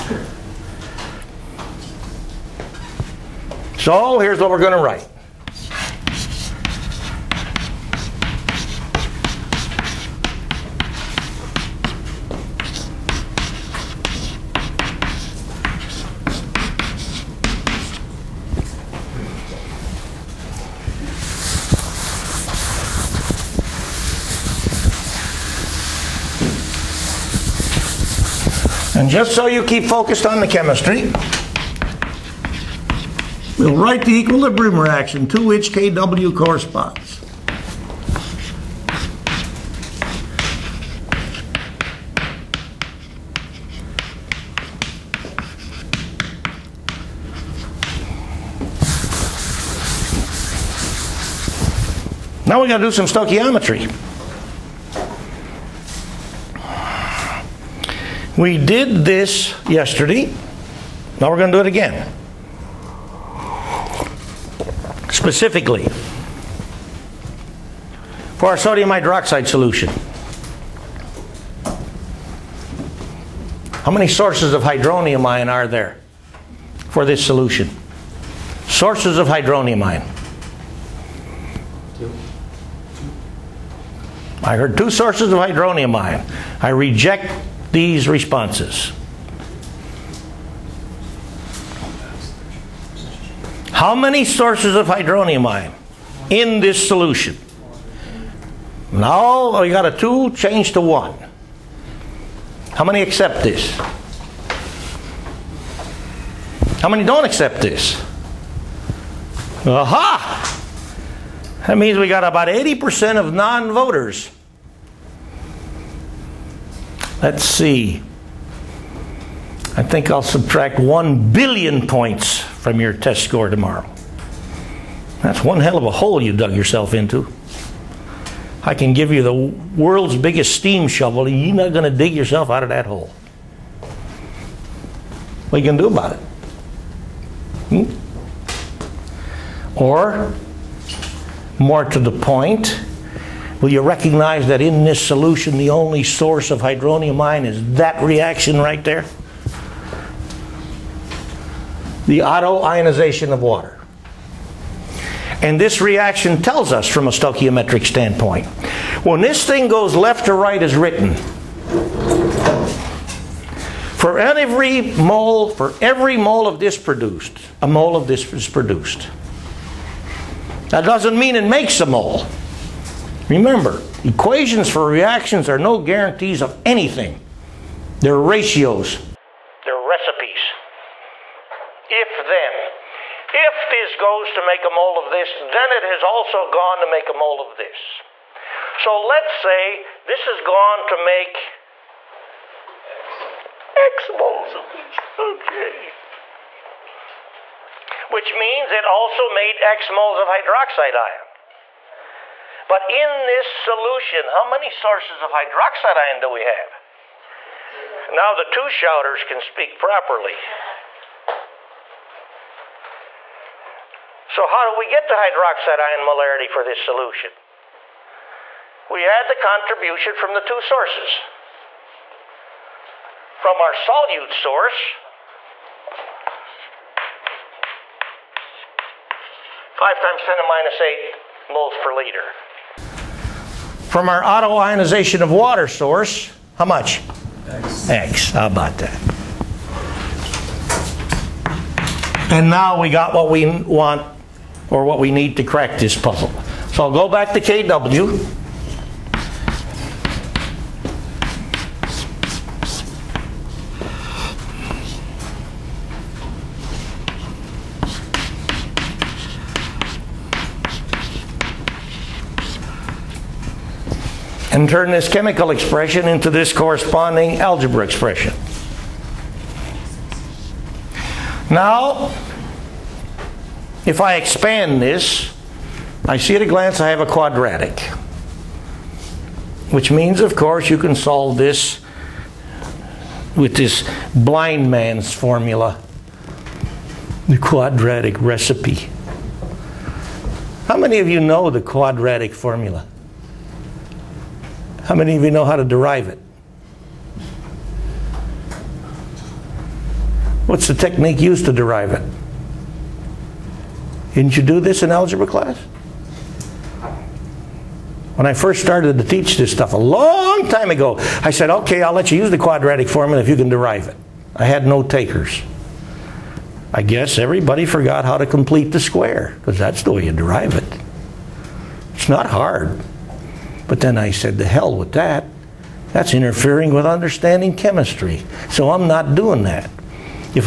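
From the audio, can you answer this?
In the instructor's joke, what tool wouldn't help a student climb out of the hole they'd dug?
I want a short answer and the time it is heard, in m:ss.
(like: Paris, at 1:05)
the world's biggest steam shovel, at 2:09.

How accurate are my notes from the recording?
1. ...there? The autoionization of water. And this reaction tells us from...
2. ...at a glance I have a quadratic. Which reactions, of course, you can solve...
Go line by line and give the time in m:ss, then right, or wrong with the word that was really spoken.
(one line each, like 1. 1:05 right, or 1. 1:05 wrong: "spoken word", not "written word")
1. 2:28 right
2. 4:36 wrong: "means", not "reactions".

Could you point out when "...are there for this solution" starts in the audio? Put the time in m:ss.
1:15.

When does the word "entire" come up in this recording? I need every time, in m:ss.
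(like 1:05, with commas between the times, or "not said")
not said.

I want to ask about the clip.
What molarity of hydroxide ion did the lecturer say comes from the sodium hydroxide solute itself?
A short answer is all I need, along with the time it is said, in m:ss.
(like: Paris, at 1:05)
5 times 10 to minus 8 moles per liter, at 3:49.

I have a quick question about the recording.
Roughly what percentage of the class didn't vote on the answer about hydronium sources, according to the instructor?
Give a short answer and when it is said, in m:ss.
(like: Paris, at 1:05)
80%, at 1:52.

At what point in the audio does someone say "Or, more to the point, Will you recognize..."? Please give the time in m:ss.
2:19.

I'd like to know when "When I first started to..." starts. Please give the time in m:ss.
5:08.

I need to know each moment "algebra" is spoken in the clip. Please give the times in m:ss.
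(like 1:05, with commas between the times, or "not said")
4:27, 5:04.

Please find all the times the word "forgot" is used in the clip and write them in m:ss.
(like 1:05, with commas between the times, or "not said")
5:17.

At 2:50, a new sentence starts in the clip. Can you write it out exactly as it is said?
That doesn't mean it makes a mole.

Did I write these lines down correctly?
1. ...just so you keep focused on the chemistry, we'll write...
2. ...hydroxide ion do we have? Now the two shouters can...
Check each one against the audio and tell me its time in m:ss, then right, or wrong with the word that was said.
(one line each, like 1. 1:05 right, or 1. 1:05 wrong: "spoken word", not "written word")
1. 0:29 right
2. 3:25 right.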